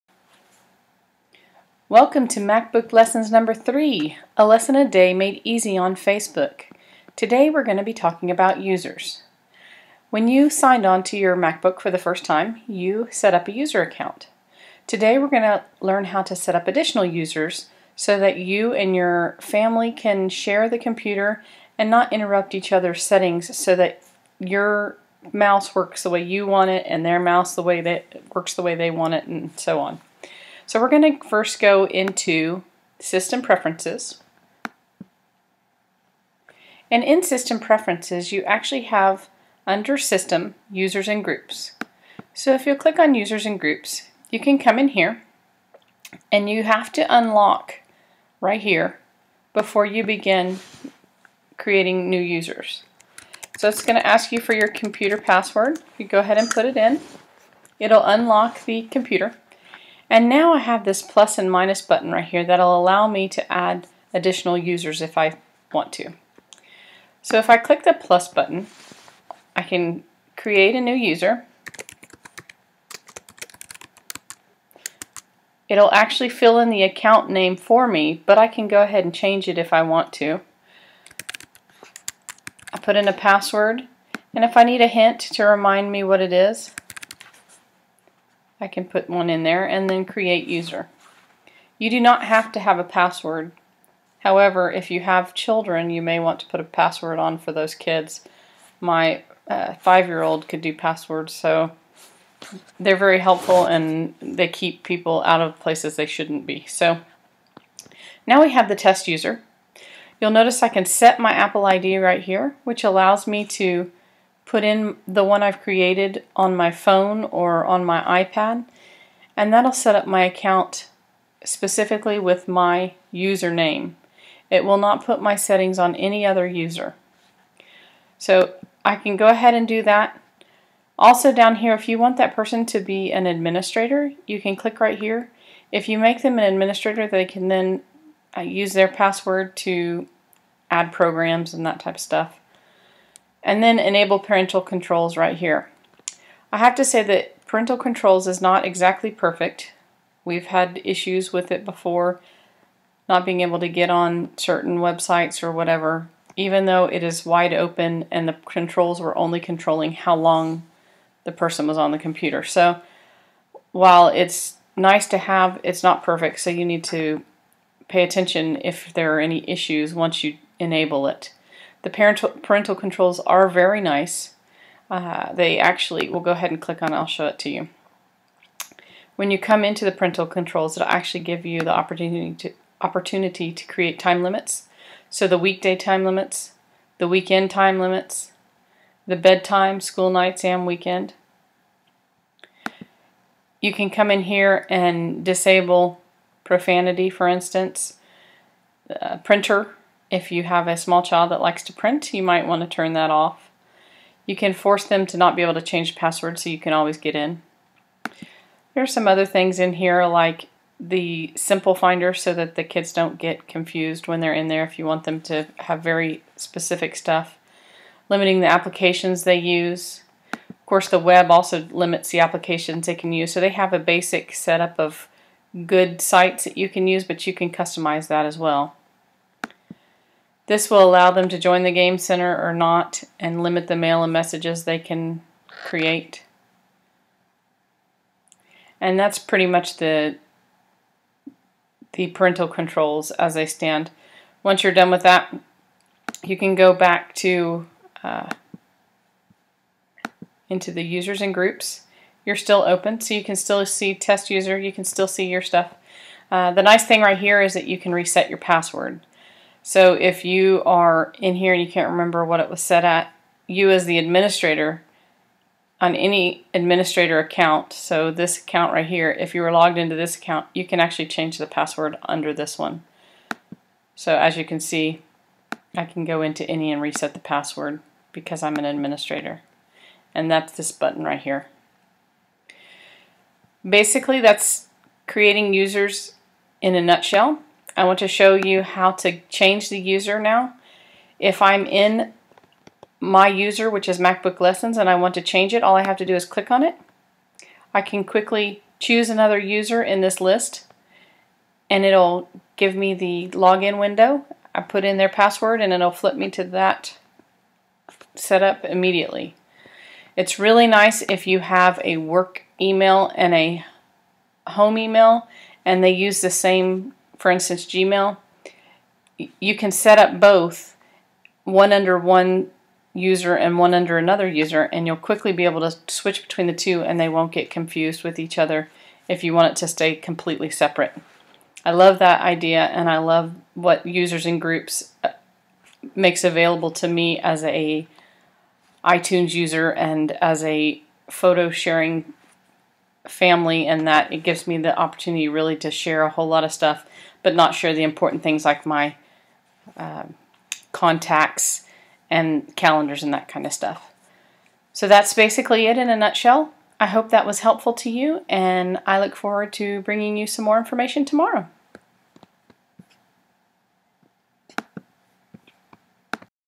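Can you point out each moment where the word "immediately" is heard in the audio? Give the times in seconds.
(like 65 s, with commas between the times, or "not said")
308 s.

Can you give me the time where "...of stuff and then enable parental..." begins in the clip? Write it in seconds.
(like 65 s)
141 s.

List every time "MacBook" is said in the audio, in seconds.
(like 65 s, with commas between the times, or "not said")
2 s, 11 s, 293 s.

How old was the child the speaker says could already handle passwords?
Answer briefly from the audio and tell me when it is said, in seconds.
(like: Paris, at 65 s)
five-year-old, at 99 s.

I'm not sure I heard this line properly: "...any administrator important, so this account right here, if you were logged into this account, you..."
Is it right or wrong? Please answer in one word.
wrong.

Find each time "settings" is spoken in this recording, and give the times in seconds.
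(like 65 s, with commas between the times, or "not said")
23 s, 125 s.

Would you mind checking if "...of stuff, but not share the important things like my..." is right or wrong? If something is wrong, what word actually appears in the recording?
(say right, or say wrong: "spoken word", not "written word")
right.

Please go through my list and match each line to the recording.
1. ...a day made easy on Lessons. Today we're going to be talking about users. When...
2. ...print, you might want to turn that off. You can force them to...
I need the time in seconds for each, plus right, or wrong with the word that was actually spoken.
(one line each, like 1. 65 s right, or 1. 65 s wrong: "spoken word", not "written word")
1. 4 s wrong: "Facebook", not "Lessons"
2. 201 s right.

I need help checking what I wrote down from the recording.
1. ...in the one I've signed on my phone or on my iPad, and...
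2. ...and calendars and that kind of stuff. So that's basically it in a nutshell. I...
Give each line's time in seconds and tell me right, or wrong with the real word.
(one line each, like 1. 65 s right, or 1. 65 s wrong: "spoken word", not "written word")
1. 114 s wrong: "created", not "signed"
2. 352 s right.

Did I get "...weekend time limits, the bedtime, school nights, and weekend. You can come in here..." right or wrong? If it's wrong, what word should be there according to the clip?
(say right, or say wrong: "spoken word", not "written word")
right.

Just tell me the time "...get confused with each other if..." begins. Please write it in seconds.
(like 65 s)
327 s.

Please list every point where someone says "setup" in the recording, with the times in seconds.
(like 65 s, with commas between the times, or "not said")
224 s, 308 s.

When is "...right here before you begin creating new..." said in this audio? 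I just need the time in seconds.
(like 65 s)
48 s.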